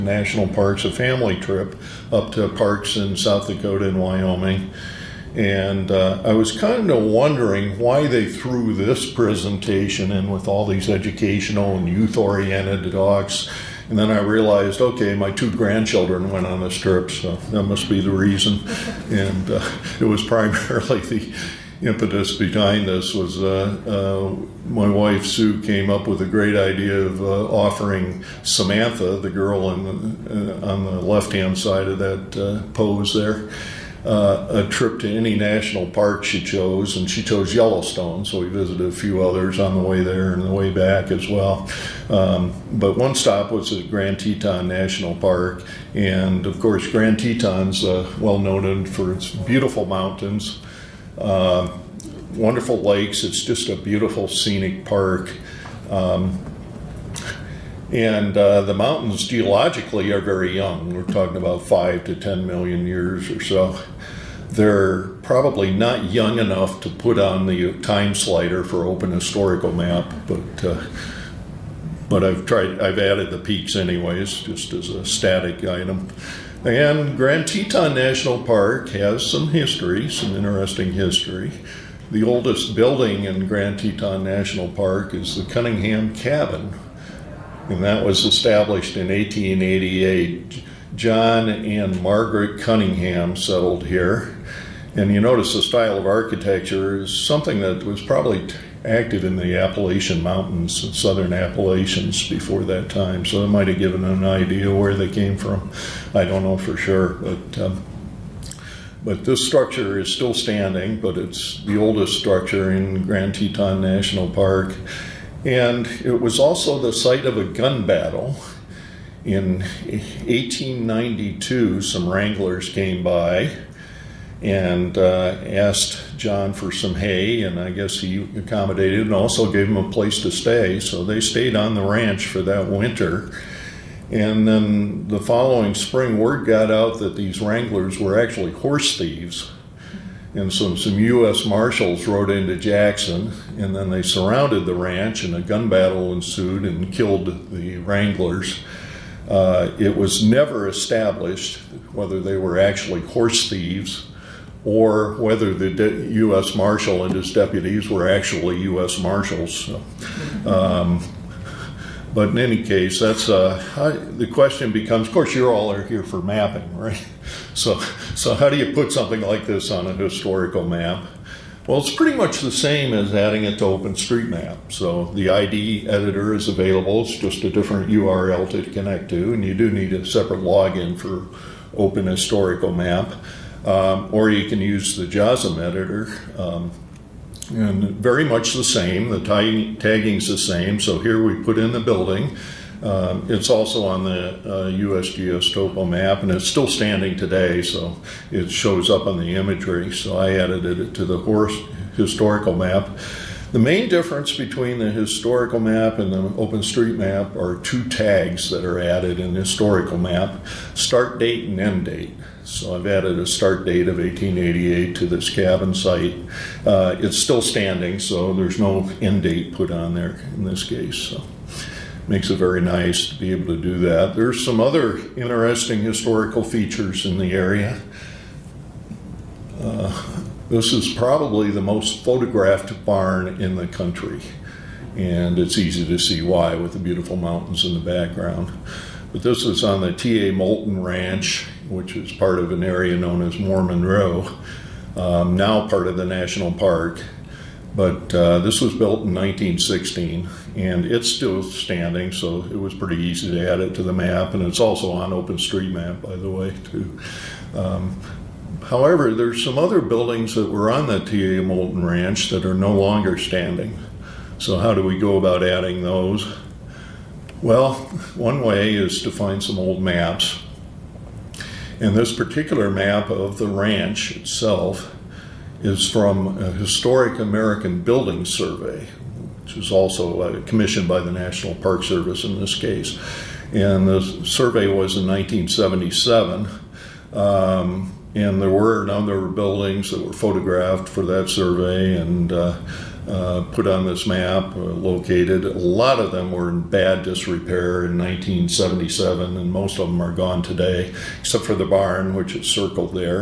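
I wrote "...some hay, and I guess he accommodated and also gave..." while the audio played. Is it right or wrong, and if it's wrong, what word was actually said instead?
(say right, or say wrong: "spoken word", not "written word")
right.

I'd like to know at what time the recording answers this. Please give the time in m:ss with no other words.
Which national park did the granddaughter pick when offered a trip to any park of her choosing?
0:37.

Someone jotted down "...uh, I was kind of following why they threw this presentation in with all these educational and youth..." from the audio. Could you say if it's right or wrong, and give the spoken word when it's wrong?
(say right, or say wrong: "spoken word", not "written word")
wrong: "wondering", not "following".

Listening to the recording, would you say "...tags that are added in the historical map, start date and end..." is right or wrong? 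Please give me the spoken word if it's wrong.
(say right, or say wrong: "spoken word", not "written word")
right.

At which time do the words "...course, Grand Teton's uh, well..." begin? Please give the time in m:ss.
0:46.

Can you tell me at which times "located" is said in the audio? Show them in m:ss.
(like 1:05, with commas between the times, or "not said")
4:54.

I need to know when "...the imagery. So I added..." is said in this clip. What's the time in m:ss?
3:19.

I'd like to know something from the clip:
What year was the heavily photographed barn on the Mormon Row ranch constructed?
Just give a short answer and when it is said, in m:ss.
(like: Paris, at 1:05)
1916, at 4:09.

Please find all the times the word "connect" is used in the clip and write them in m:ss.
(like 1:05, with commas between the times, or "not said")
2:58.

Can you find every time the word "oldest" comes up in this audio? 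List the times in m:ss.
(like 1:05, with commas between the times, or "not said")
1:22, 1:51.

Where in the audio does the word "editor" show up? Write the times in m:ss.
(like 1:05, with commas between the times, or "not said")
2:55, 3:05.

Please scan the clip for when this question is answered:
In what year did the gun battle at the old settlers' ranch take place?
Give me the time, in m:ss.
1:59.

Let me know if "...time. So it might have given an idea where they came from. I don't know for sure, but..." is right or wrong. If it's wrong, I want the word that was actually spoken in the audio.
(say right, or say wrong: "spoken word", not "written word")
right.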